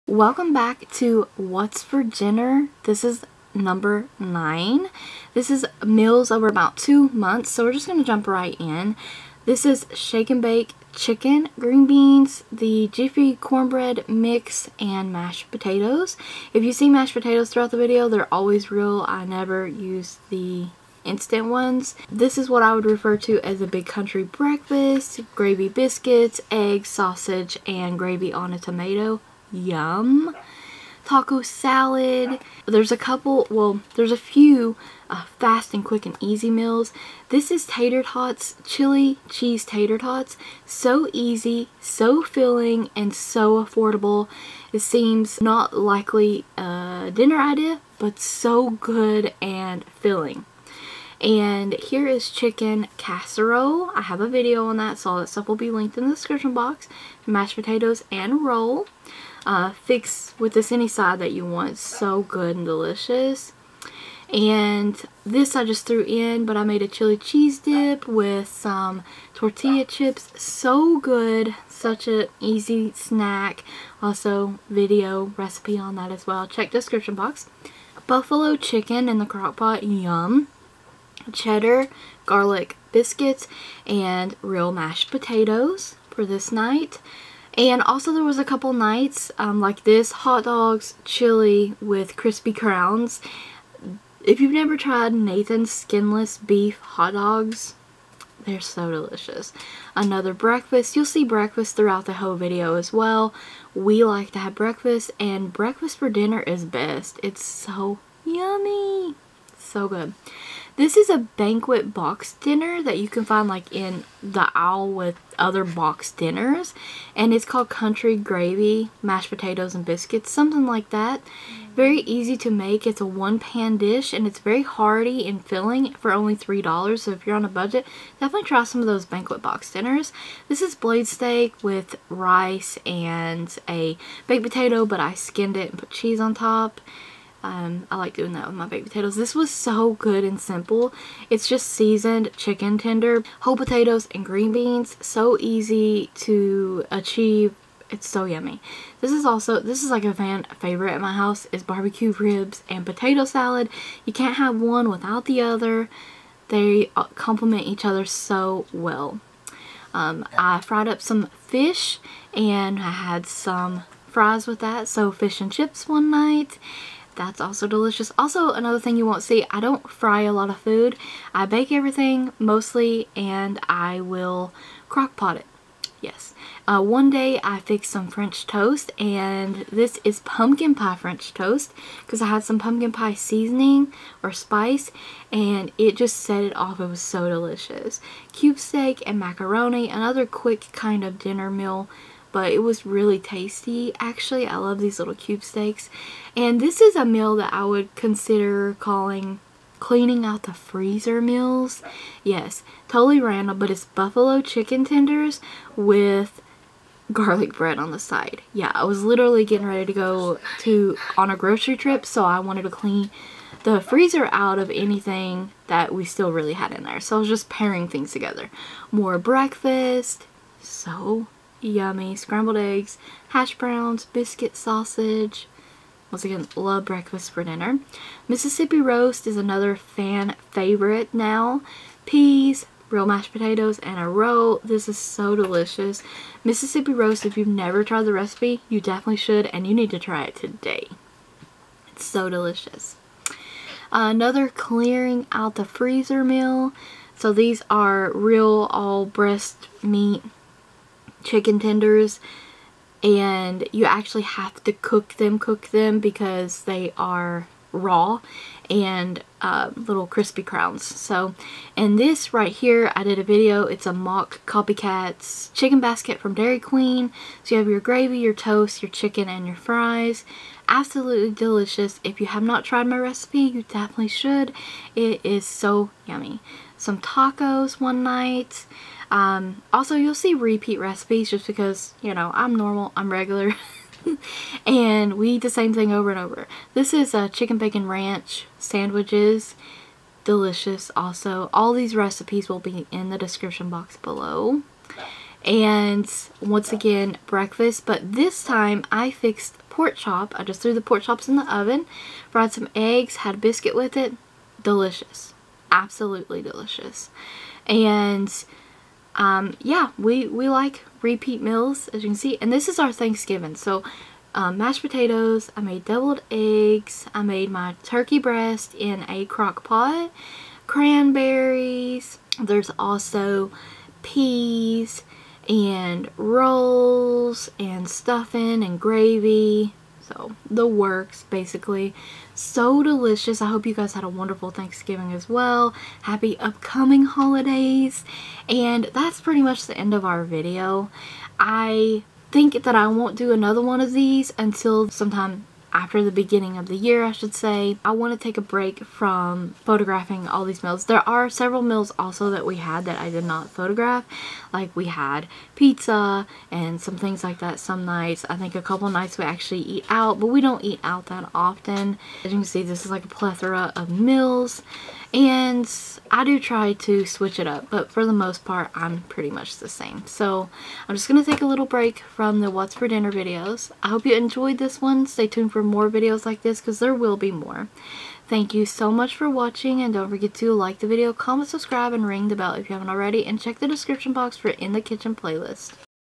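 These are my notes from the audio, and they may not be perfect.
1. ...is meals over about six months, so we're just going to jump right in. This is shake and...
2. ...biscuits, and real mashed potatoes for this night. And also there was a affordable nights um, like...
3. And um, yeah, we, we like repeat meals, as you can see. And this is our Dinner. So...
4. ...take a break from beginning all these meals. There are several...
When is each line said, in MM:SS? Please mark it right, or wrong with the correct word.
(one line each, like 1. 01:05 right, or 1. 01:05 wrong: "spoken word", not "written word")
1. 00:05 wrong: "two", not "six"
2. 01:22 wrong: "couple", not "affordable"
3. 05:07 wrong: "Thanksgiving", not "Dinner"
4. 05:48 wrong: "photographing", not "beginning".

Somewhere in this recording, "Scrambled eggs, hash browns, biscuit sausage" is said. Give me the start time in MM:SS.
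03:42.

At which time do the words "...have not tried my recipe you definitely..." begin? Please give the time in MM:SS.
04:32.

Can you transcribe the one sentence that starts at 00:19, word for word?
I never use the instant ones.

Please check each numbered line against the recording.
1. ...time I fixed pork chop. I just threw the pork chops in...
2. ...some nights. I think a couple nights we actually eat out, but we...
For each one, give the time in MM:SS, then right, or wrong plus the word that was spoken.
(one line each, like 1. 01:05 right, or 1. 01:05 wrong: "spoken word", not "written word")
1. 04:58 right
2. 05:57 right.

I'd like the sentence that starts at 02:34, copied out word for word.
You can't have one without the other.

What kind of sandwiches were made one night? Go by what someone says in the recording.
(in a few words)
chicken bacon ranch.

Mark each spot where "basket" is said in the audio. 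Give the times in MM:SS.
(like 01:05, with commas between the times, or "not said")
04:25.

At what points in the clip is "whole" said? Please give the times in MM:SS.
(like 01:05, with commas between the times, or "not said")
01:42, 02:23.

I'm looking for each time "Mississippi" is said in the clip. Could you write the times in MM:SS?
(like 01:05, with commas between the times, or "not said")
03:48, 03:56.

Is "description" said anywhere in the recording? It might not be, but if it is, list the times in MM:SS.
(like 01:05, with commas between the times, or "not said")
00:56, 01:16, 04:53, 06:23.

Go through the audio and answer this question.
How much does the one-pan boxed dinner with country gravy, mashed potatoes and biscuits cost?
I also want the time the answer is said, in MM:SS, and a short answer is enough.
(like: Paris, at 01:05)
$3, at 02:06.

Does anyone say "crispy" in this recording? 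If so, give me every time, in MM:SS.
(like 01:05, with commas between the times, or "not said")
01:32, 04:20.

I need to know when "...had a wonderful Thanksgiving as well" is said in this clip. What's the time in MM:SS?
05:33.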